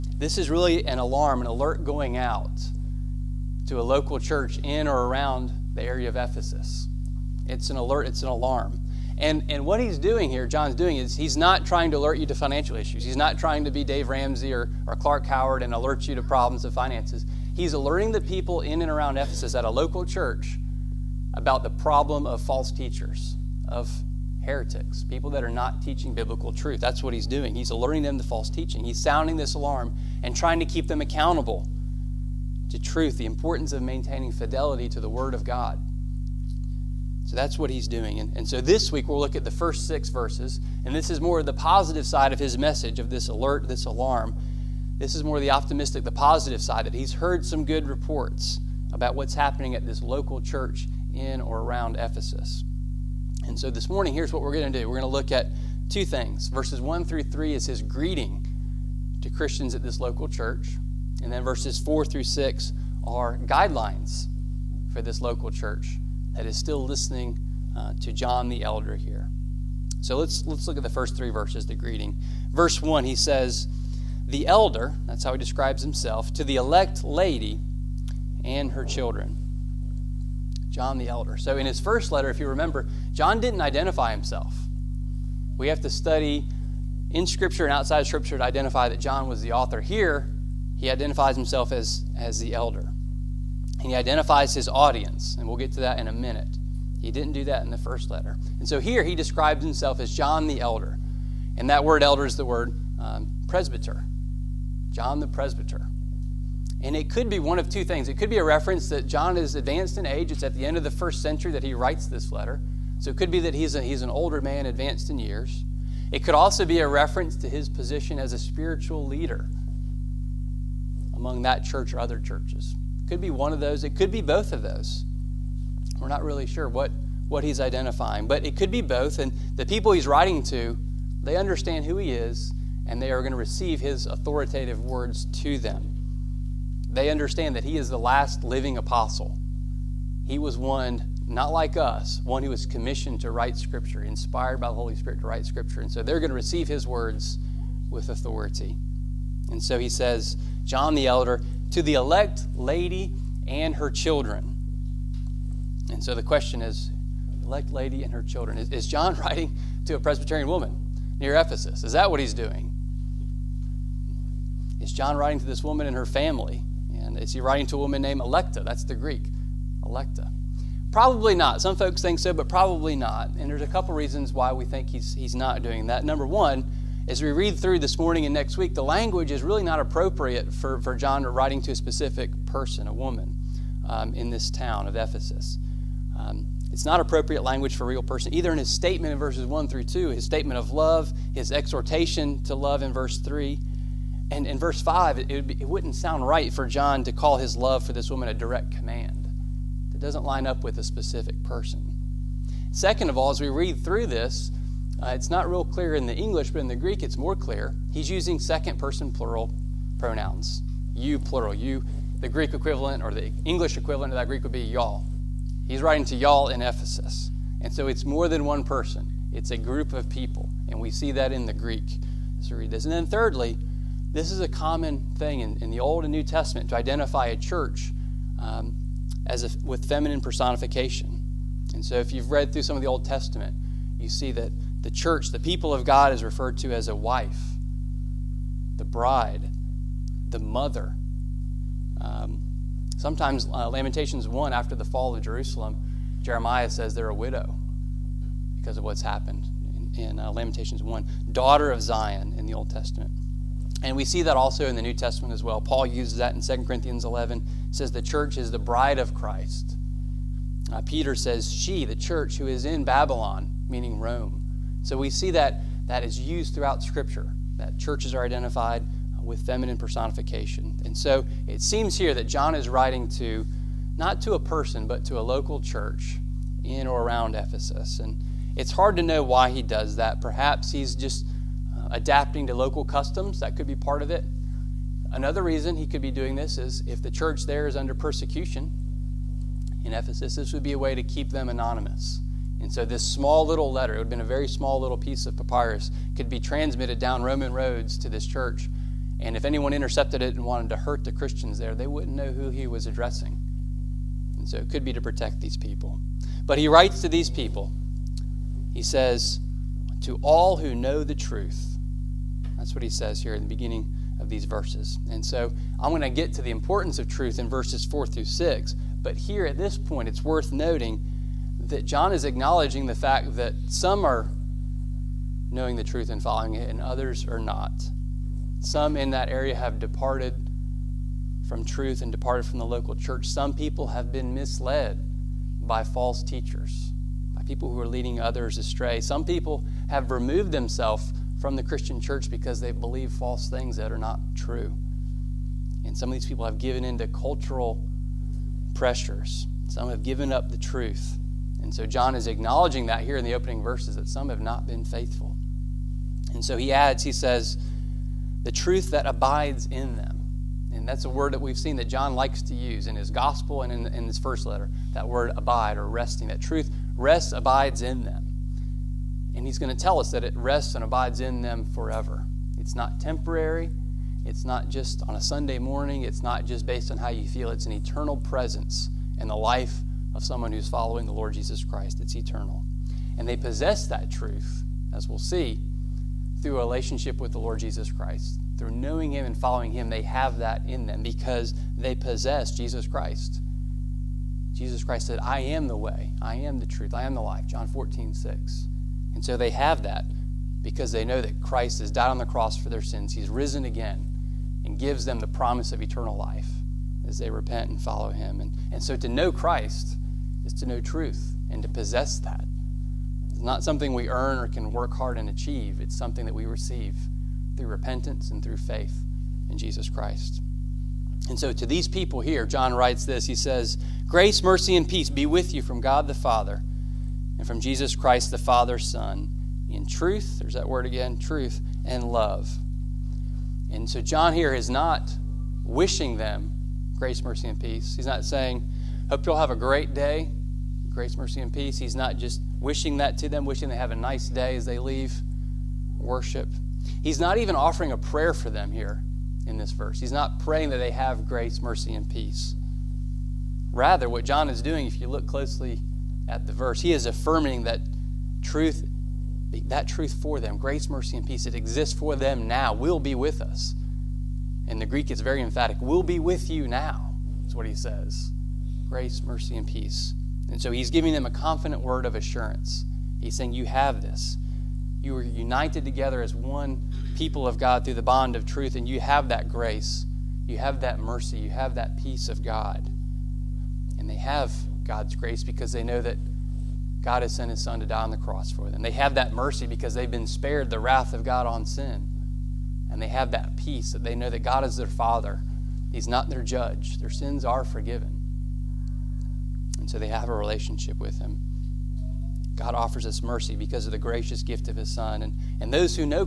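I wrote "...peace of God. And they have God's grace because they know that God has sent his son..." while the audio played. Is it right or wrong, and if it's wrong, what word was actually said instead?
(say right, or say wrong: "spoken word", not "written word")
right.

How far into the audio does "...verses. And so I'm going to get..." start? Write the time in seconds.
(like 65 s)
314 s.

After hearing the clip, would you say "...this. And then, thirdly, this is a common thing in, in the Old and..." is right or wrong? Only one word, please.
right.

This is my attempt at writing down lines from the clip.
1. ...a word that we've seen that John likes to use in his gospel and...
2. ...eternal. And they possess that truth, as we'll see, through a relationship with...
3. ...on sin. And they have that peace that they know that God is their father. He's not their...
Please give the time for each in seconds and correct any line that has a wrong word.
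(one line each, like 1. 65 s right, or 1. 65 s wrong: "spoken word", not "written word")
1. 361 s right
2. 382 s right
3. 491 s right.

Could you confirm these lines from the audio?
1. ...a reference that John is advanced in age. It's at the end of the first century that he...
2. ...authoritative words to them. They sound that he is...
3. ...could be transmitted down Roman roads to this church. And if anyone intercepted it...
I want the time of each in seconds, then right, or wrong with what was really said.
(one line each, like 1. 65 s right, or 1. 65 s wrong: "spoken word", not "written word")
1. 108 s right
2. 134 s wrong: "understand", not "sound"
3. 296 s right.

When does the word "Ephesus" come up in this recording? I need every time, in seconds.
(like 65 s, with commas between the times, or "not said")
6 s, 19 s, 51 s, 161 s, 184 s, 216 s, 277 s, 289 s.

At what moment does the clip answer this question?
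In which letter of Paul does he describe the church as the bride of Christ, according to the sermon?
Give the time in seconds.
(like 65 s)
256 s.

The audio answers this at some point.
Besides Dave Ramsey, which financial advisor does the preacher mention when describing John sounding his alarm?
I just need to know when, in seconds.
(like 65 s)
14 s.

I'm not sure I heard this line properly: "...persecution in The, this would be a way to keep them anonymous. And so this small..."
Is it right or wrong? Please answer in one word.
wrong.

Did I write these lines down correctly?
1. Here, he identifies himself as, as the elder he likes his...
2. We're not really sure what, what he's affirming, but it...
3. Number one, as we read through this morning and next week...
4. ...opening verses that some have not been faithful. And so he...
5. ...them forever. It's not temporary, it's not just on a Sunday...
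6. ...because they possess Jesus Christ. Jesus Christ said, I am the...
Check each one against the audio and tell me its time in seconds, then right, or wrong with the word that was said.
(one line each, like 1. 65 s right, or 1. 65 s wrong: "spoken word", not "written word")
1. 89 s wrong: "identifies", not "likes"
2. 125 s wrong: "identifying", not "affirming"
3. 176 s right
4. 353 s right
5. 371 s right
6. 391 s right.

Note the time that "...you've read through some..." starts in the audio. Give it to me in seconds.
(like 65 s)
232 s.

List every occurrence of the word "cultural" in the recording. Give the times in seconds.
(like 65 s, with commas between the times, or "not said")
347 s.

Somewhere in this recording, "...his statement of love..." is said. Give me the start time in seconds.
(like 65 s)
190 s.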